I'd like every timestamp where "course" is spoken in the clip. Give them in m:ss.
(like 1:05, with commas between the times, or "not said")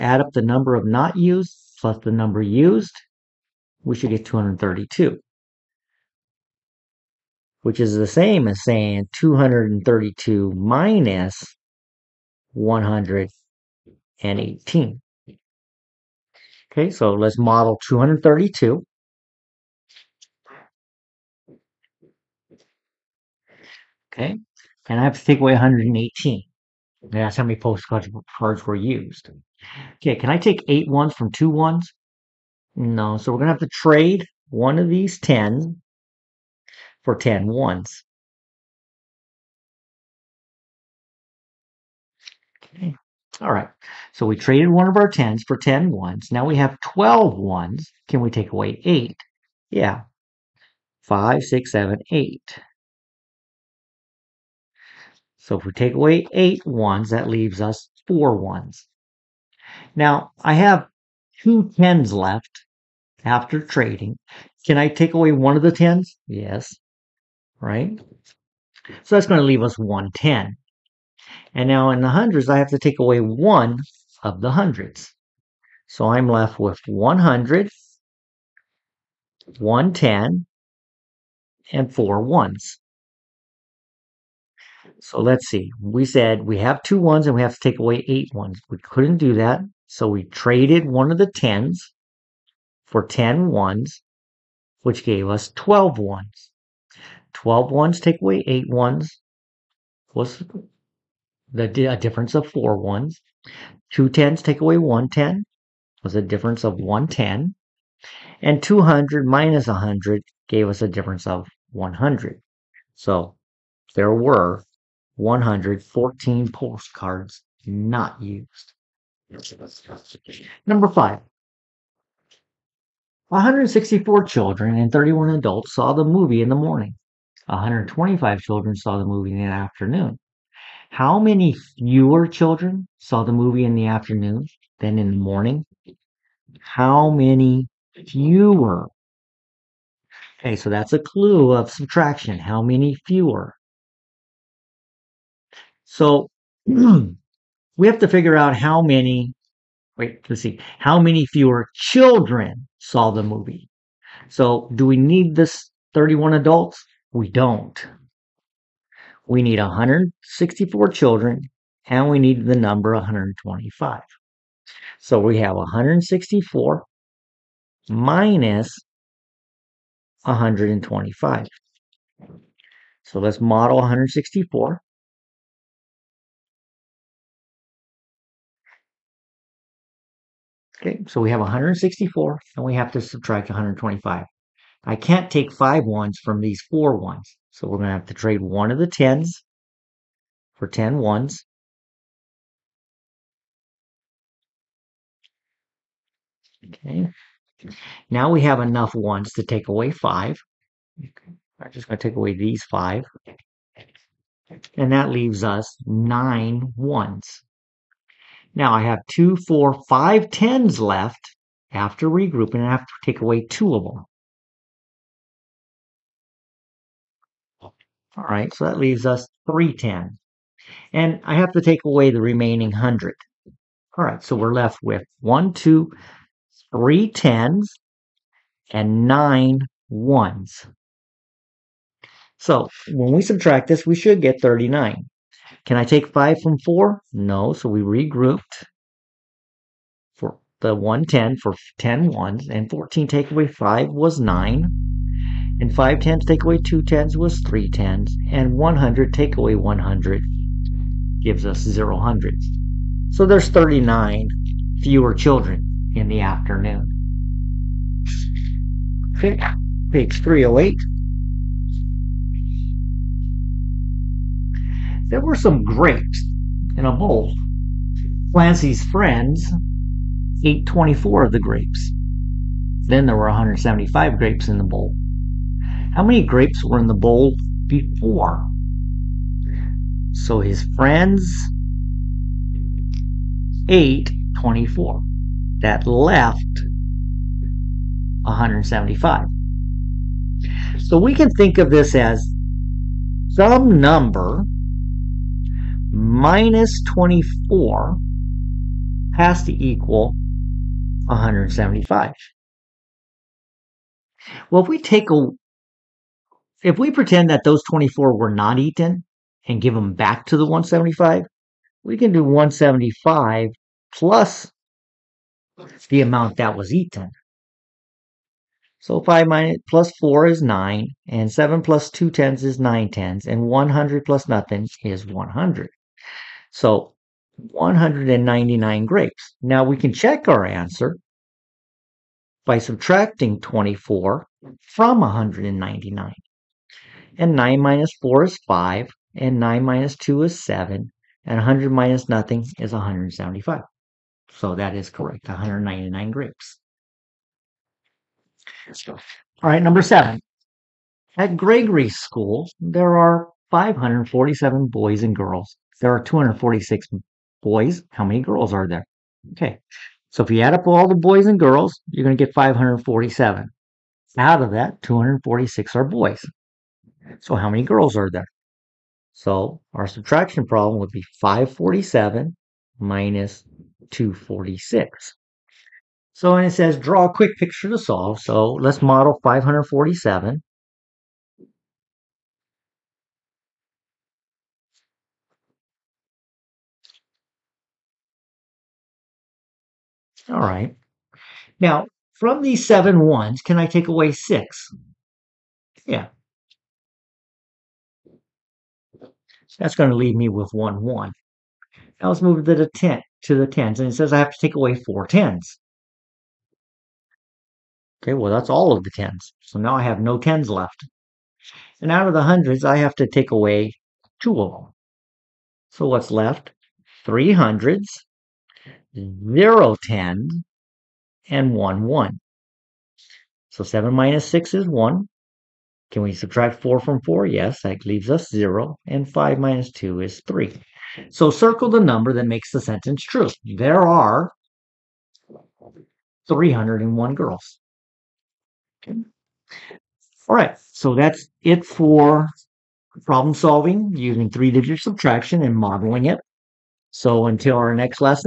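not said.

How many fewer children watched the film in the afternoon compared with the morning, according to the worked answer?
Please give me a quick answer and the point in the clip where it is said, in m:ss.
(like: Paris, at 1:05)
39, at 4:13.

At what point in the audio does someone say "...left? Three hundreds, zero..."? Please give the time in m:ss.
6:56.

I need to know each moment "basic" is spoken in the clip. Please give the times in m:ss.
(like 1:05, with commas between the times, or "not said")
not said.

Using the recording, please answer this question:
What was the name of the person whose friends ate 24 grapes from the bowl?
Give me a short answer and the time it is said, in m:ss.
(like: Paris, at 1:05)
Clancy, at 4:28.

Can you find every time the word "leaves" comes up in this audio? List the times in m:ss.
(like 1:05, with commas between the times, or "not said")
0:57, 1:09, 3:25, 3:38, 6:39, 7:07.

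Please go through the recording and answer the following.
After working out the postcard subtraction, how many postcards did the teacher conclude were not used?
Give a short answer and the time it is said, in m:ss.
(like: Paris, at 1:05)
114, at 1:55.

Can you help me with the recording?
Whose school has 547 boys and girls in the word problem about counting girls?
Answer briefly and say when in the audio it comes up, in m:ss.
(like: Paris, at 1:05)
Gregory, at 5:51.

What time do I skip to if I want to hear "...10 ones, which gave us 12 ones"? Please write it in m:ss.
1:33.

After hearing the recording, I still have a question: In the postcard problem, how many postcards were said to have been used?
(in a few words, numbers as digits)
118.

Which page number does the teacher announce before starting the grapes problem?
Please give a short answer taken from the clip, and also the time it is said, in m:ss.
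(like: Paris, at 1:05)
308, at 4:19.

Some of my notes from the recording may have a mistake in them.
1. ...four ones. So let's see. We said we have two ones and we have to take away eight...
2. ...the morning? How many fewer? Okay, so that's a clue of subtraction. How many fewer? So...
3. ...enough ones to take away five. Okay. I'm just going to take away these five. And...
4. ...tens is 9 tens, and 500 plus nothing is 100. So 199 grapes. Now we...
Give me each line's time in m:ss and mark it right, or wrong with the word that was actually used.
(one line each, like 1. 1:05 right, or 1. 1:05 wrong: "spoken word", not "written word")
1. 1:21 right
2. 2:15 right
3. 3:18 right
4. 5:22 wrong: "100", not "500".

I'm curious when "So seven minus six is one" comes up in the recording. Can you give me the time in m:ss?
7:03.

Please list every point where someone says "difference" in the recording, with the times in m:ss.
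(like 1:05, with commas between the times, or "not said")
1:41, 1:46, 1:50.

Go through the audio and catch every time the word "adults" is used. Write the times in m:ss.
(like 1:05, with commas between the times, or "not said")
2:05, 2:36.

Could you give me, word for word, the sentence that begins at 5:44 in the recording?
So that is correct, 199 grapes.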